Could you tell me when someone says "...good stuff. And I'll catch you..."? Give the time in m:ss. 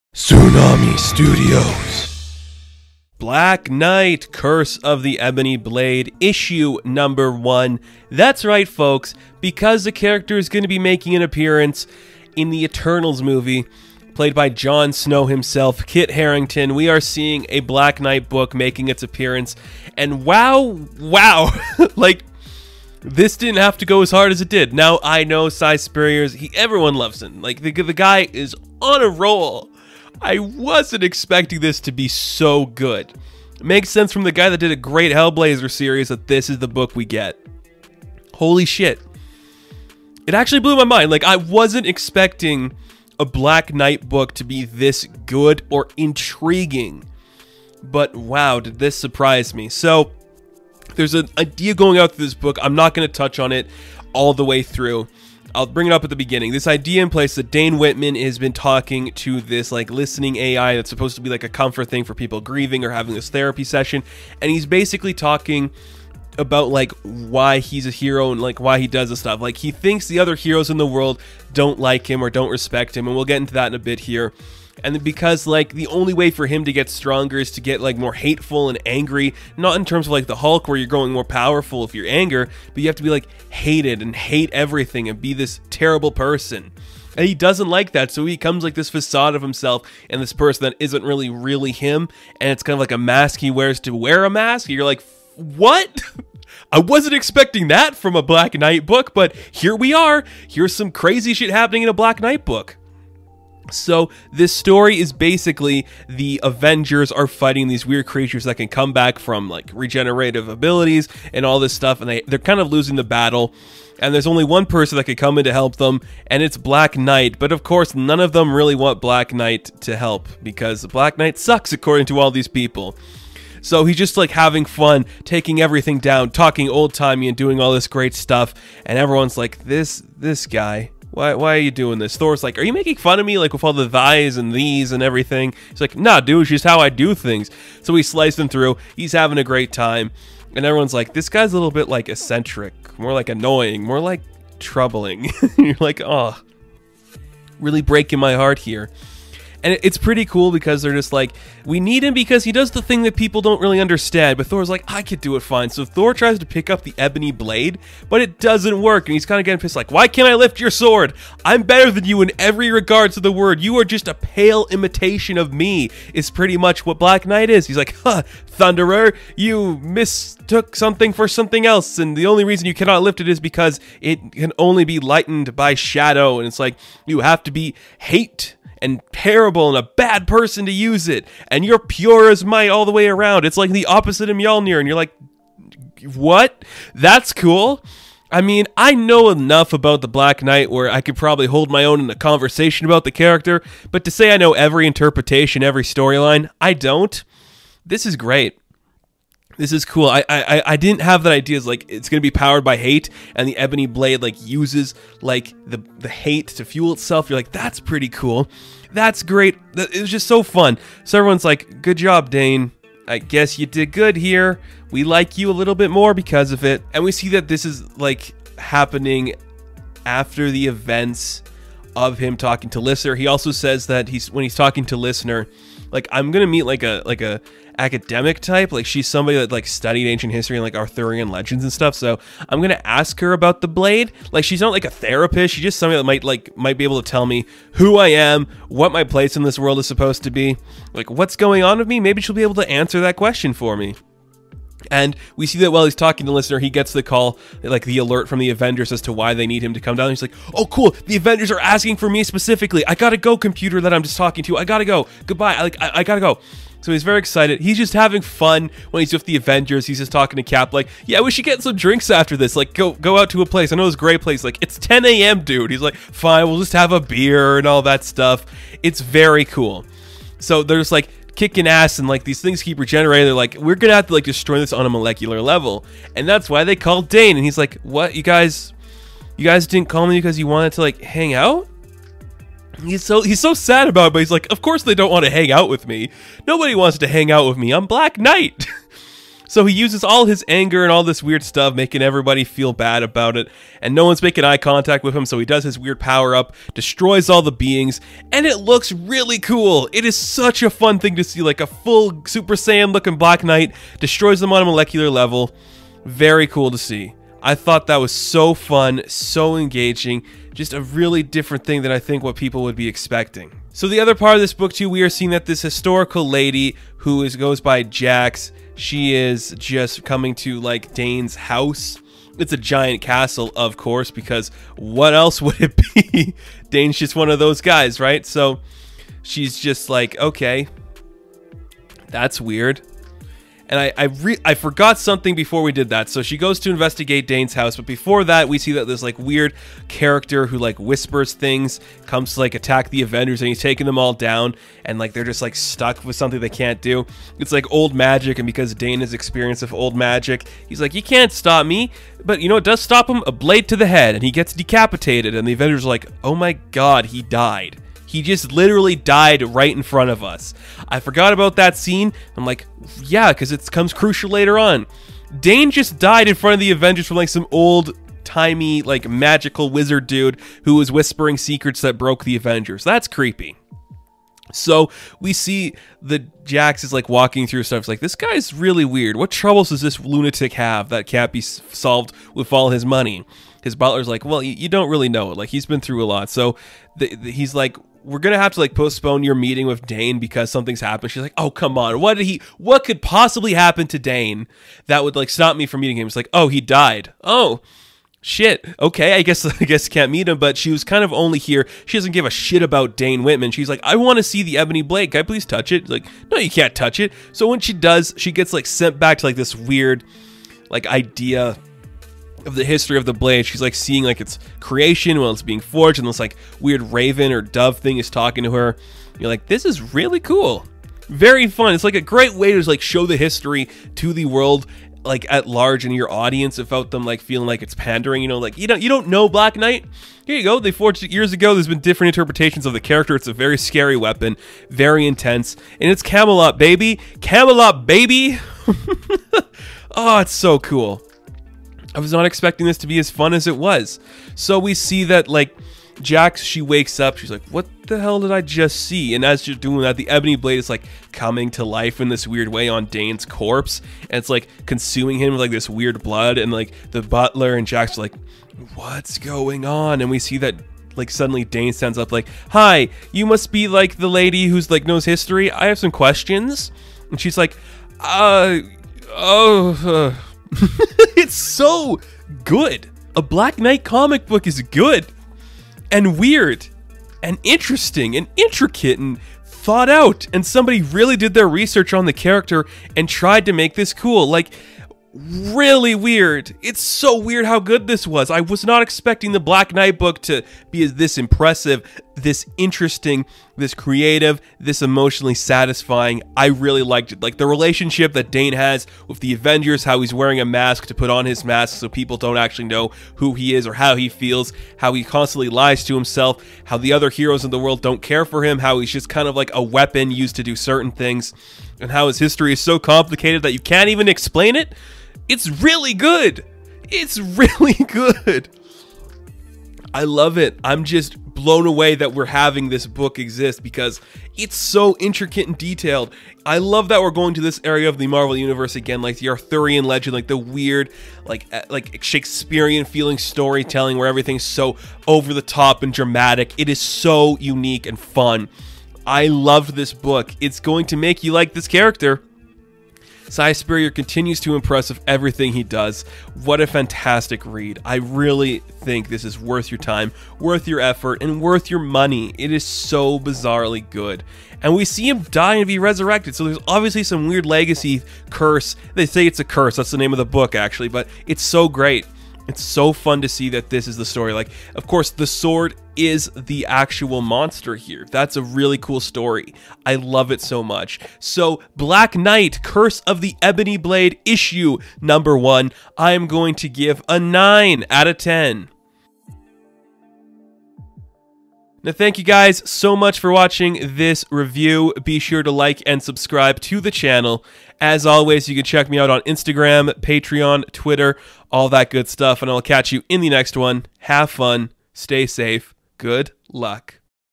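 9:51.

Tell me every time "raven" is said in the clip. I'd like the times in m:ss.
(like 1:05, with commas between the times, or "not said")
6:56.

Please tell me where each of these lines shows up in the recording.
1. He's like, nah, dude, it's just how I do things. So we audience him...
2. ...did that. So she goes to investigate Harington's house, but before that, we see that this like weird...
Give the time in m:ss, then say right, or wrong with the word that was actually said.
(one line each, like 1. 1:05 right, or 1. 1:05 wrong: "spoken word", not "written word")
1. 2:15 wrong: "slice", not "audience"
2. 5:35 wrong: "Dane", not "Harington".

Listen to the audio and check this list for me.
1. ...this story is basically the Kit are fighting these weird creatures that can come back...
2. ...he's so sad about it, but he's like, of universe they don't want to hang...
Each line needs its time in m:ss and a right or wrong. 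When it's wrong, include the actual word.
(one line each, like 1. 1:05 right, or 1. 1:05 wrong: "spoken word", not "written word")
1. 1:44 wrong: "Avengers", not "Kit"
2. 4:43 wrong: "course", not "universe".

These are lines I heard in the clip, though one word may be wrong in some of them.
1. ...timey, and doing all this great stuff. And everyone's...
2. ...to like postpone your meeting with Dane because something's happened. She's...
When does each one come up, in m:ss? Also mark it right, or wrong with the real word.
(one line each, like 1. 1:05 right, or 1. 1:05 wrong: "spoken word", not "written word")
1. 2:06 right
2. 6:28 right.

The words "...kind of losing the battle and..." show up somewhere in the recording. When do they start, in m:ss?
1:52.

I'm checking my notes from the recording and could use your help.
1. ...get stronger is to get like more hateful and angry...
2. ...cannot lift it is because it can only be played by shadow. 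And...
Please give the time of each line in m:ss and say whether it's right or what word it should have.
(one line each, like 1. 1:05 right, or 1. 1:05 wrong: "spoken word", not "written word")
1. 1:16 right
2. 2:52 wrong: "lightened", not "played".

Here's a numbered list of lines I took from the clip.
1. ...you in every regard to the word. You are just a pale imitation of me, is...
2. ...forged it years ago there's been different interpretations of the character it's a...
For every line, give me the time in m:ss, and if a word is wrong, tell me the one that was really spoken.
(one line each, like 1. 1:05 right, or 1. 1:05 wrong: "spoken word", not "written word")
1. 2:42 right
2. 7:10 right.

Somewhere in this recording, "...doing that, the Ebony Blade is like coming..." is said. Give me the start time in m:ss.
7:29.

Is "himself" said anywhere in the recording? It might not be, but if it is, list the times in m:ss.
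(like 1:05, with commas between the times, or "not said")
0:15, 1:29, 8:25.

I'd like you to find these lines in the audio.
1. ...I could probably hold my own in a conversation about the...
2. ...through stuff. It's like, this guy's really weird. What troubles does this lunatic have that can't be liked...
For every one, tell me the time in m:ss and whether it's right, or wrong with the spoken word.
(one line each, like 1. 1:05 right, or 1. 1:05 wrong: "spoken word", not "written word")
1. 3:10 right
2. 6:17 wrong: "solved", not "liked".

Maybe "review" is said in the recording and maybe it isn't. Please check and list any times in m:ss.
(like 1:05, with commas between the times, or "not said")
9:44.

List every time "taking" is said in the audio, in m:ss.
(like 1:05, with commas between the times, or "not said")
2:05, 5:43.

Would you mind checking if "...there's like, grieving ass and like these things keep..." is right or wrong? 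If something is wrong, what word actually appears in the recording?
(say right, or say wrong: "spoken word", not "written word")
wrong: "kicking", not "grieving".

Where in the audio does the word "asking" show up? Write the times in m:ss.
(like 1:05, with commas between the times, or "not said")
4:11.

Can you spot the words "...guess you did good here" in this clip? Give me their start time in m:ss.
3:33.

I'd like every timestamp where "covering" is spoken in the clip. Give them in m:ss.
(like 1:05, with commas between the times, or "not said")
not said.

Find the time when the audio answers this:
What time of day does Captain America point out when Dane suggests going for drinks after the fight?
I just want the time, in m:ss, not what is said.
4:24.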